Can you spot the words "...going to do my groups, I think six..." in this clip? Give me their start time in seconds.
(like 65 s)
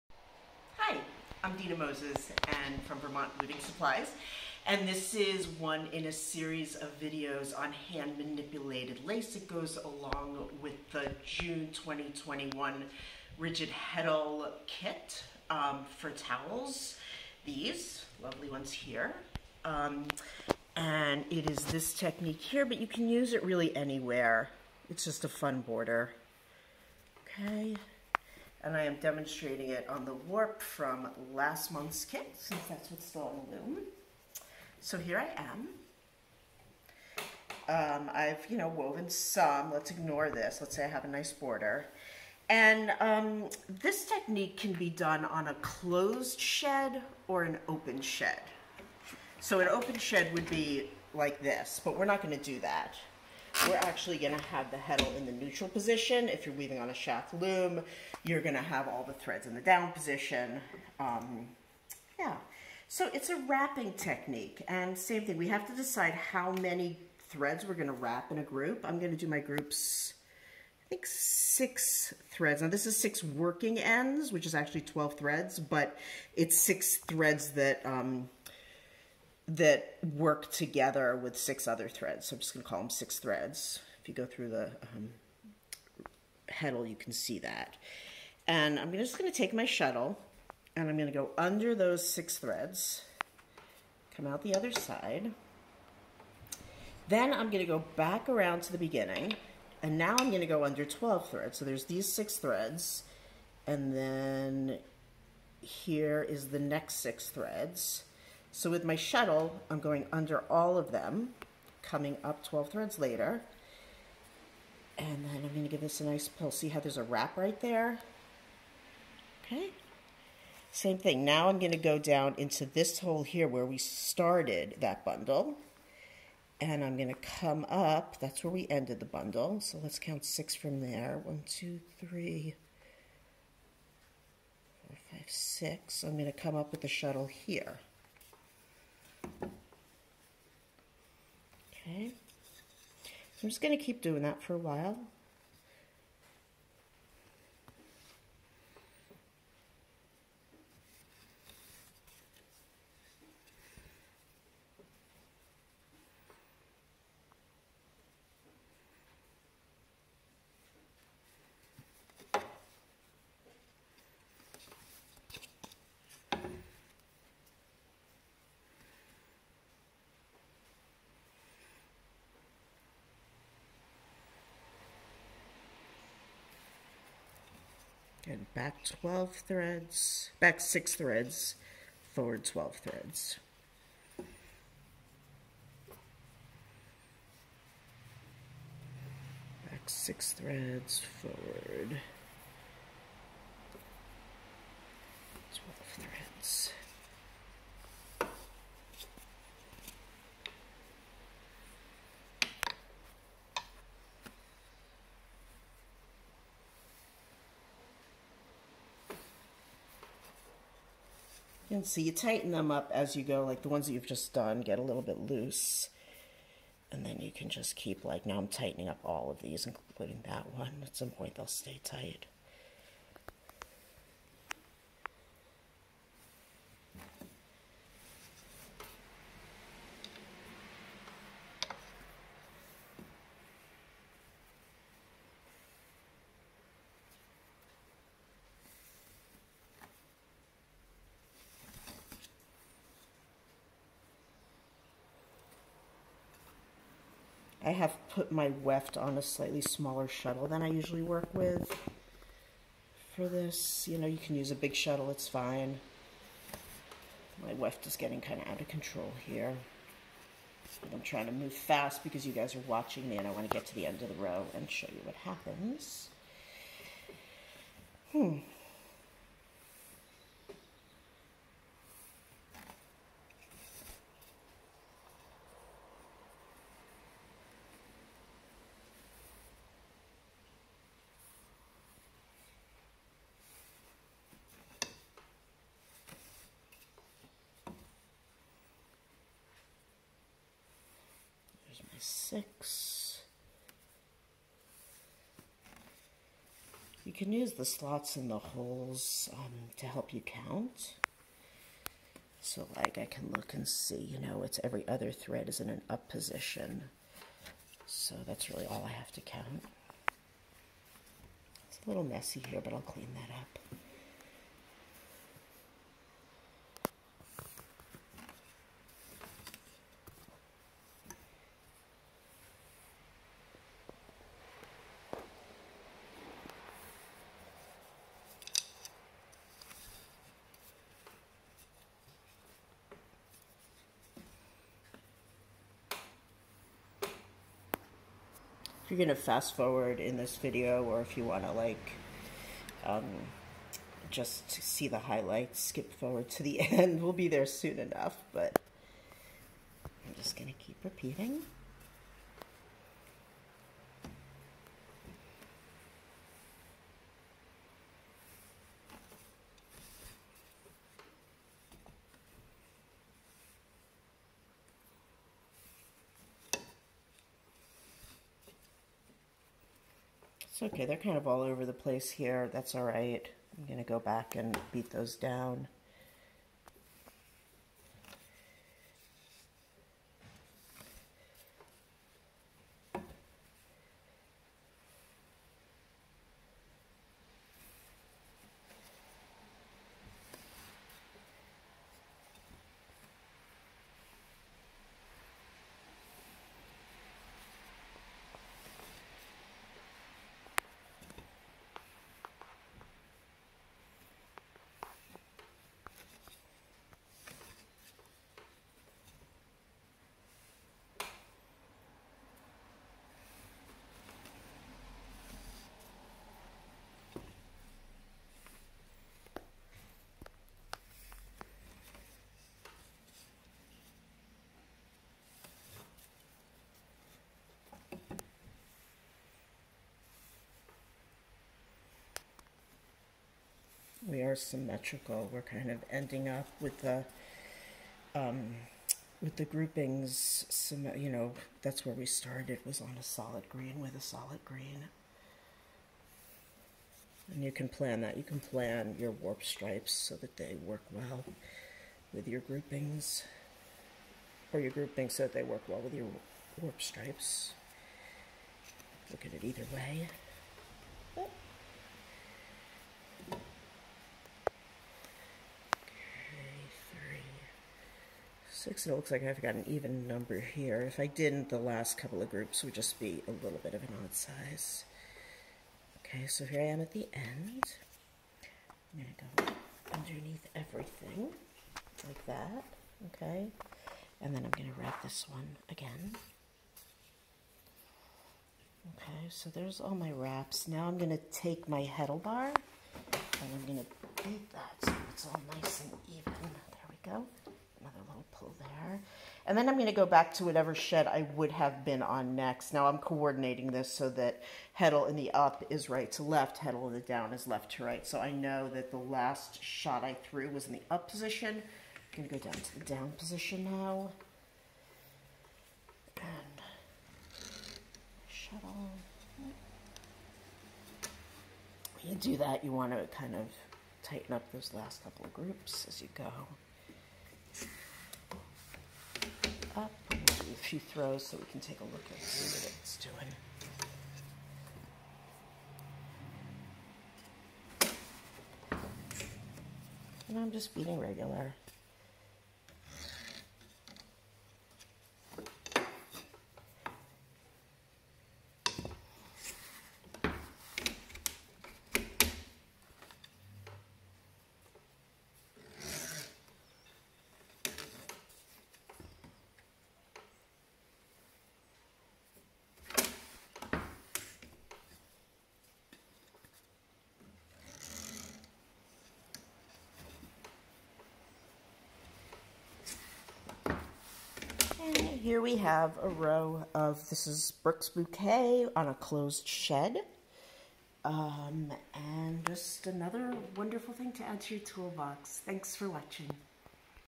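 68 s.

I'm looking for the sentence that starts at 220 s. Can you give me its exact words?
At some point they'll stay tight.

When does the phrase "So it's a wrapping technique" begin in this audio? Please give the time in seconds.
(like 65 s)
62 s.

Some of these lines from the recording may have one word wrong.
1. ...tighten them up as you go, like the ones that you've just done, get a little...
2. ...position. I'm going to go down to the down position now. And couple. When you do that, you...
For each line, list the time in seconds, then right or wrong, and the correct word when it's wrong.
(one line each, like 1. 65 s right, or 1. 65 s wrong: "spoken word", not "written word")
1. 212 s right
2. 511 s wrong: "shuttle", not "couple".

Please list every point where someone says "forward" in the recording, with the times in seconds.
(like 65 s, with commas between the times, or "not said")
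182 s, 191 s, 339 s, 345 s.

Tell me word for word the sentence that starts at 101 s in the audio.
So there's these six threads and then here is the next six threads.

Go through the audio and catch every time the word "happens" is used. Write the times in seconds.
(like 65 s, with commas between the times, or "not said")
265 s.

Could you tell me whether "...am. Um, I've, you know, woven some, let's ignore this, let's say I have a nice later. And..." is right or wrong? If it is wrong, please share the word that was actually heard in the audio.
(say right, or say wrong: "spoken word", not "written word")
wrong: "border", not "later".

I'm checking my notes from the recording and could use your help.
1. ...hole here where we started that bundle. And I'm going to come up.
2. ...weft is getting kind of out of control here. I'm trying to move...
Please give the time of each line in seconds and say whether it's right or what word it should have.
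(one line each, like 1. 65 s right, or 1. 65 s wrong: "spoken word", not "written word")
1. 122 s right
2. 257 s right.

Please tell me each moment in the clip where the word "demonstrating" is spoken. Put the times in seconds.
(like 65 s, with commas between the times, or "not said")
29 s.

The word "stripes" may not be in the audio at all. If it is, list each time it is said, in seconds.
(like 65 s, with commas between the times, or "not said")
449 s, 456 s.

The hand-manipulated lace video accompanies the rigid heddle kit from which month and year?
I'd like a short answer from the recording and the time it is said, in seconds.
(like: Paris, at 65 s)
June 2021, at 11 s.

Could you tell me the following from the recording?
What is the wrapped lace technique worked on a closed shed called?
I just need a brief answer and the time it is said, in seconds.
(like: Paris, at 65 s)
Brooks Bouquet, at 577 s.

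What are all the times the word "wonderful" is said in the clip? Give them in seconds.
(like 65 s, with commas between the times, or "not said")
583 s.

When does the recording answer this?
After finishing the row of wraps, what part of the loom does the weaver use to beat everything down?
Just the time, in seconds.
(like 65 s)
491 s.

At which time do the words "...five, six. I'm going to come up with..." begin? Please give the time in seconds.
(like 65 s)
135 s.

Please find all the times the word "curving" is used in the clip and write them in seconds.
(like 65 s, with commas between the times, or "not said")
not said.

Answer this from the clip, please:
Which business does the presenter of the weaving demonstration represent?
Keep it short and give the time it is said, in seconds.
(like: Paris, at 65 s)
Vermont Weaving Supplies, at 2 s.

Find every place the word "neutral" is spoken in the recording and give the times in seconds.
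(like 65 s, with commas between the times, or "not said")
55 s.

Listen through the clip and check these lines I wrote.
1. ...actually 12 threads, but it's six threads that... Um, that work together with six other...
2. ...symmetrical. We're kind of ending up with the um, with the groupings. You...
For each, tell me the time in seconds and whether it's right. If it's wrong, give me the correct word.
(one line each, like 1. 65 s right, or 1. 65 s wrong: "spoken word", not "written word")
1. 74 s right
2. 434 s right.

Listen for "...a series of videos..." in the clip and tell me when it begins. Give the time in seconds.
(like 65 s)
6 s.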